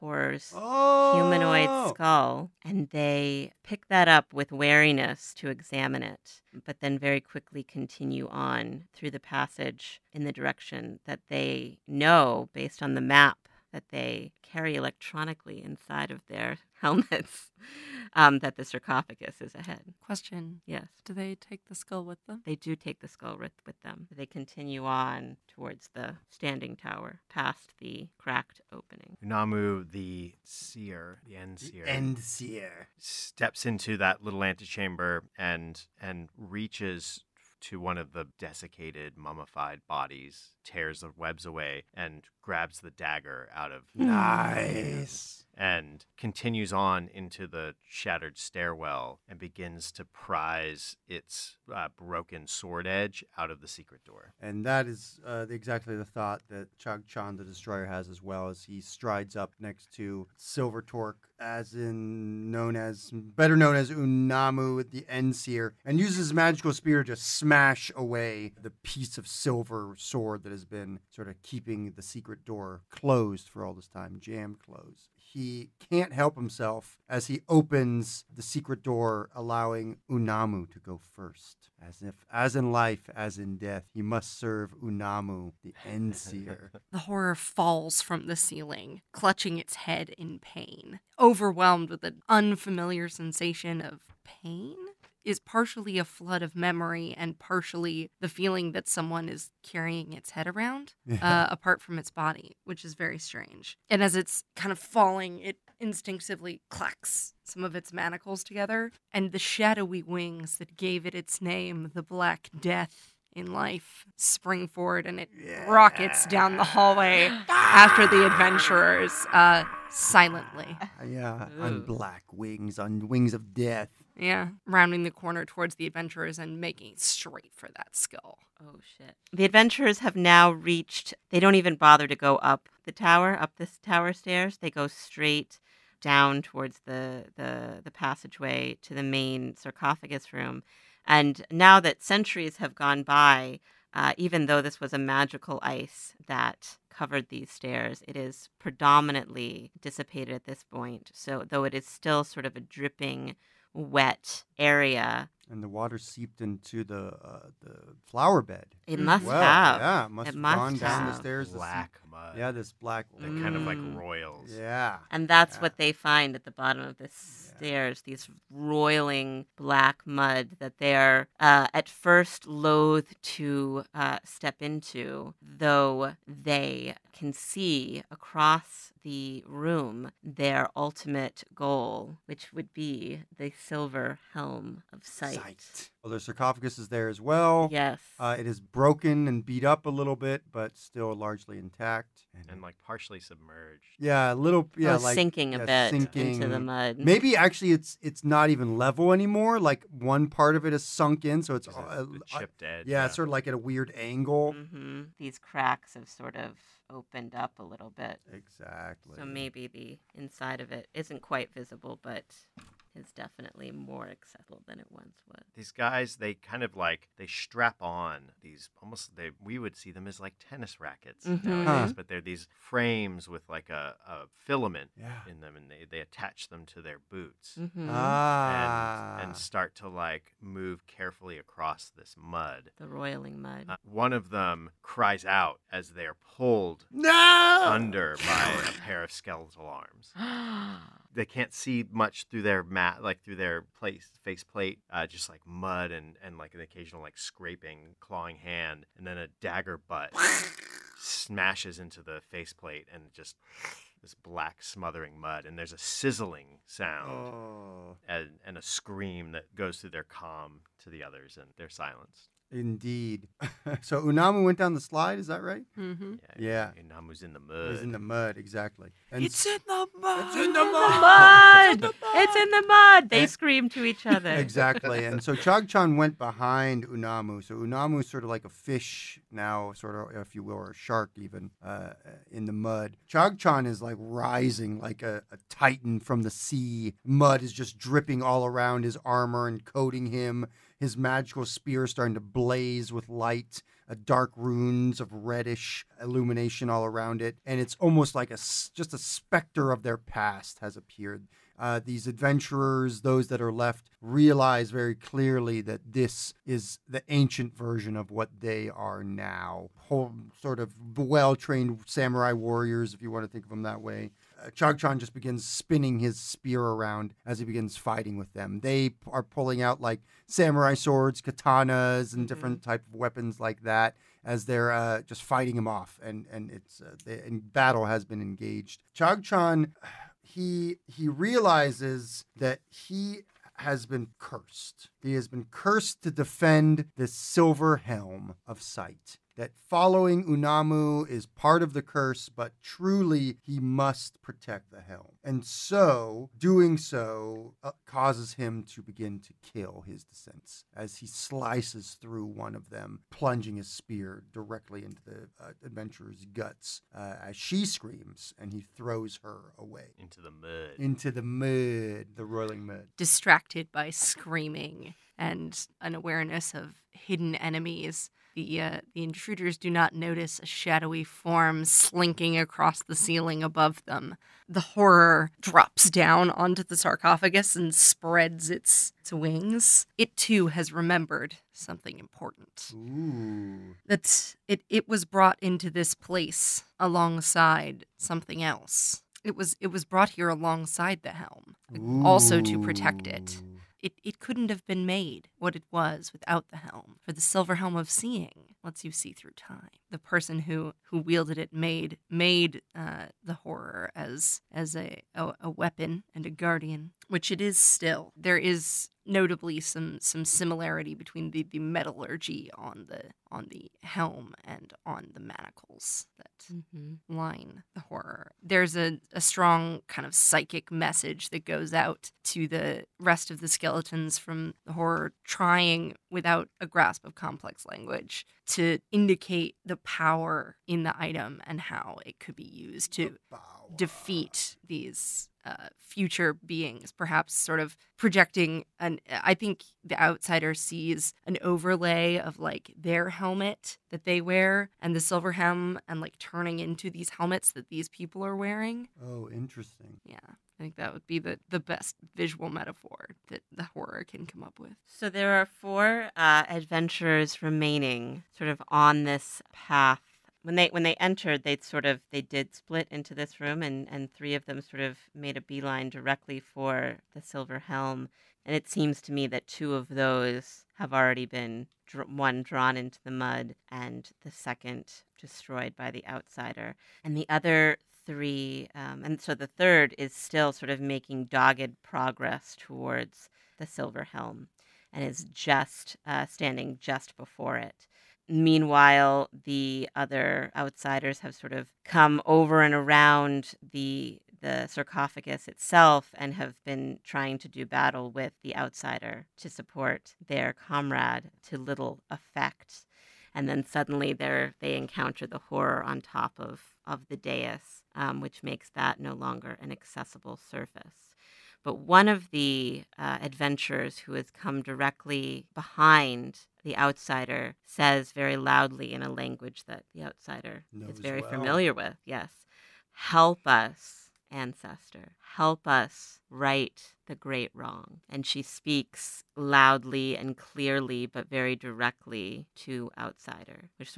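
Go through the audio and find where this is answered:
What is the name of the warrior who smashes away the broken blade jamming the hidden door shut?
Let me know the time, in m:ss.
0:56.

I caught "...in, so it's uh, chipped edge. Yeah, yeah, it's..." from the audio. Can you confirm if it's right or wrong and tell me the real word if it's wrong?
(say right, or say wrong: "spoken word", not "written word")
right.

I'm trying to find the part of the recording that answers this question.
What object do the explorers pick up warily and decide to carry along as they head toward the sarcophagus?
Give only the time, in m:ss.
0:01.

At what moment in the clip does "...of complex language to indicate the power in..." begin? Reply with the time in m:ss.
7:07.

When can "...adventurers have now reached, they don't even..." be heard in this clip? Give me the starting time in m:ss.
2:09.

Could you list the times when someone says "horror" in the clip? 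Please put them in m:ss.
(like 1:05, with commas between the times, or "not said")
1:26, 6:14, 6:43, 6:57, 7:04, 7:33, 8:25.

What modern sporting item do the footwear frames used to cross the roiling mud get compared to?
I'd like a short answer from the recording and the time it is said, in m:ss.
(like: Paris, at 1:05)
Tennis rackets, at 3:40.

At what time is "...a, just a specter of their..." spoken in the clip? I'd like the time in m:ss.
4:58.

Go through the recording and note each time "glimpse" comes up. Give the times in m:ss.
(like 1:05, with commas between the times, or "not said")
not said.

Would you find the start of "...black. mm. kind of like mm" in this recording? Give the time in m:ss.
2:42.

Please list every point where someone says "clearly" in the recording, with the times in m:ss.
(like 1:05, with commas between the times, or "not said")
5:04, 8:50.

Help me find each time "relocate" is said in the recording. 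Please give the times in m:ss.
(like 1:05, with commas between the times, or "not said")
not said.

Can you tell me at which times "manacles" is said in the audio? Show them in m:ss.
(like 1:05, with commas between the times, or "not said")
1:47, 6:55.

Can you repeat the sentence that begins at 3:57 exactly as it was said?
under by a pair of skeletal arms.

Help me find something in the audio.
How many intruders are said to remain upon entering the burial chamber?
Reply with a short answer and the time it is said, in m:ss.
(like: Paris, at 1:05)
4, at 7:35.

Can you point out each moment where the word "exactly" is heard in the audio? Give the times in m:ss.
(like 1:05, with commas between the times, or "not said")
0:55, 3:28, 4:28, 4:34.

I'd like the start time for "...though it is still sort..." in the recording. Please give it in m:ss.
2:31.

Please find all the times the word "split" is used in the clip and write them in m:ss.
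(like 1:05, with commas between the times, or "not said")
7:42.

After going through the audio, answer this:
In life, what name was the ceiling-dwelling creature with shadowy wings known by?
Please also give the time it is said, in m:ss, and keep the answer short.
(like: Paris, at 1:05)
The Black Death, at 1:51.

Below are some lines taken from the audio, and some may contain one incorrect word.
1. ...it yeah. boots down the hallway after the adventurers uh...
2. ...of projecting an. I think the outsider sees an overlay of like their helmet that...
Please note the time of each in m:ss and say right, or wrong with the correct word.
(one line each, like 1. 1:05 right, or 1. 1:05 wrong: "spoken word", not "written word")
1. 1:55 wrong: "rockets", not "boots"
2. 7:17 right.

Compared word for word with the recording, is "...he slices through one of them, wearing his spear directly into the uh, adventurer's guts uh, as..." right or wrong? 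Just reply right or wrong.
wrong.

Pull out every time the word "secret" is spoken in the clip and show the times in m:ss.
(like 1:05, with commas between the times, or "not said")
0:53, 1:12, 1:18.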